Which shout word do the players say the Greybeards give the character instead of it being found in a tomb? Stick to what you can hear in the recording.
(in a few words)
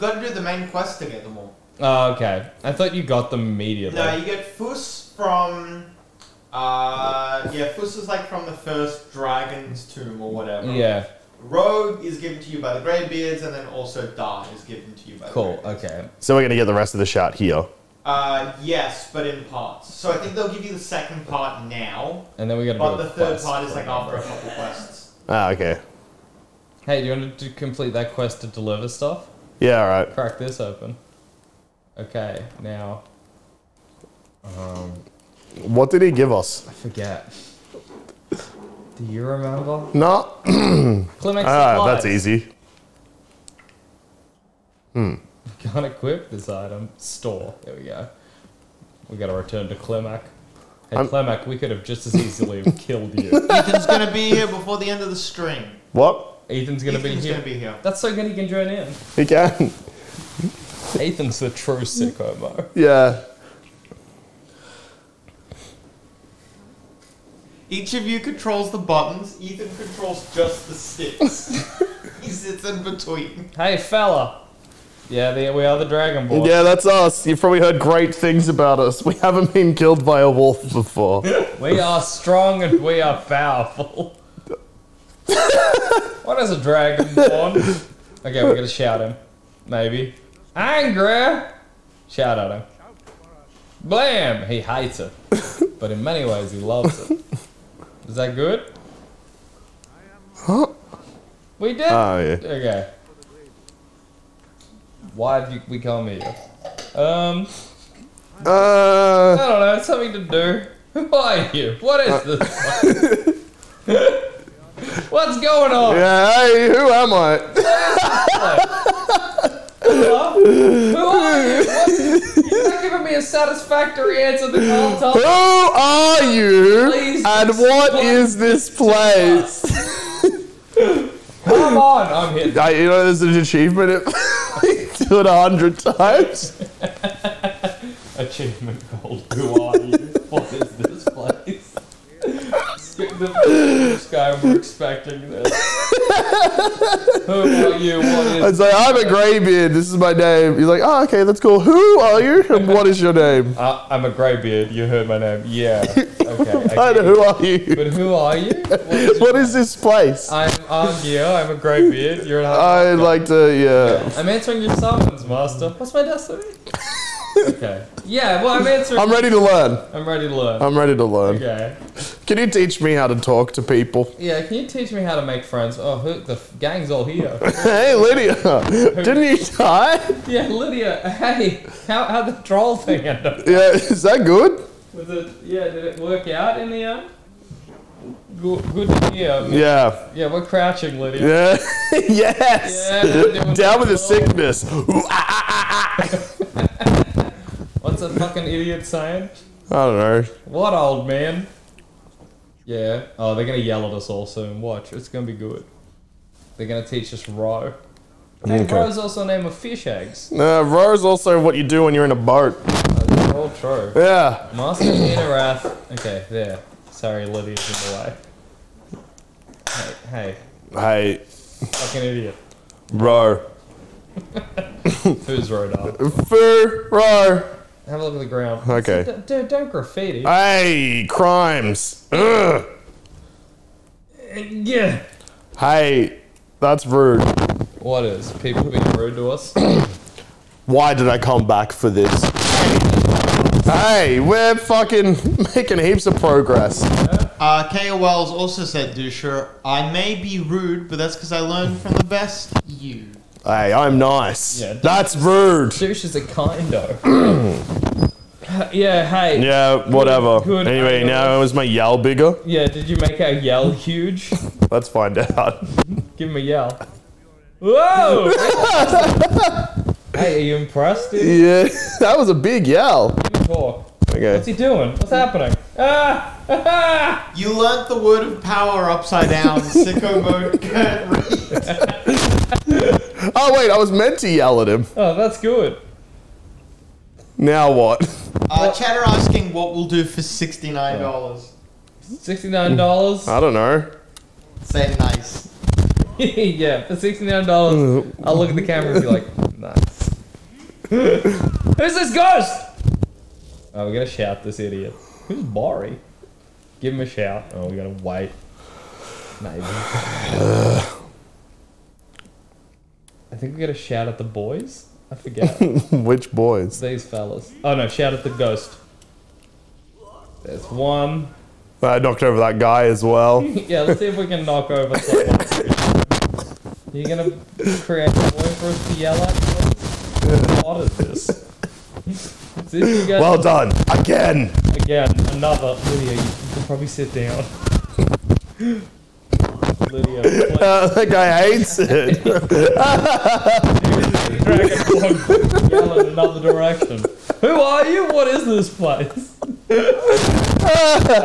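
Rogue.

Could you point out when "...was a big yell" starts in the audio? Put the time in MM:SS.
04:32.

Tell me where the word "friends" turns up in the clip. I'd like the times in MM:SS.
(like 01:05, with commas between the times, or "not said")
02:55.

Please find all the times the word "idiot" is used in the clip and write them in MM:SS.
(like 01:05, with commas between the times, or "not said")
03:18, 03:42, 05:04.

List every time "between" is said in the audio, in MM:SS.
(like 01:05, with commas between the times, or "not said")
01:12.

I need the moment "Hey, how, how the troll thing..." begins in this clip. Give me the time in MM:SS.
03:01.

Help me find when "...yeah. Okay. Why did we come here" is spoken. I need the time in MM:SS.
01:42.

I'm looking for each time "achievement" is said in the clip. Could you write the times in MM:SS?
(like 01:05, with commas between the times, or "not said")
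02:13, 02:18.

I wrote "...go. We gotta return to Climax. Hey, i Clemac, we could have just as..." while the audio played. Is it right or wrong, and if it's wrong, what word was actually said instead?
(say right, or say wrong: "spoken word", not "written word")
wrong: "Clemac", not "Climax".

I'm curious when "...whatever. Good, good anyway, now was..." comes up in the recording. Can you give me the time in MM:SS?
04:19.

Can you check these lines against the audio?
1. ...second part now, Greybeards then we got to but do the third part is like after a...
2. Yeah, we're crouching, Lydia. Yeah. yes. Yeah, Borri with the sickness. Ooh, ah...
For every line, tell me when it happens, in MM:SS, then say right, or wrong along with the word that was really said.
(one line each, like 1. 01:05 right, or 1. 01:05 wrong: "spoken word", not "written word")
1. 00:20 wrong: "And", not "Greybeards"
2. 03:10 wrong: "Down", not "Borri".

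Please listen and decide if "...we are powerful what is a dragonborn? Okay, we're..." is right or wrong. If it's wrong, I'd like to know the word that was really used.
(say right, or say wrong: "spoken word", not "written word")
right.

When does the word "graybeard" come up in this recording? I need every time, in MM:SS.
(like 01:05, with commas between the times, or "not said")
02:29, 02:34, 02:41.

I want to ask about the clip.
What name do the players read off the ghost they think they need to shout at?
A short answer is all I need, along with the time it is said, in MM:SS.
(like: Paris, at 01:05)
Borri, at 05:05.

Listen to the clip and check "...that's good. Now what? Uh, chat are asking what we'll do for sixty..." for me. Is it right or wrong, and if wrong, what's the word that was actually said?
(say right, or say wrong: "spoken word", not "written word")
right.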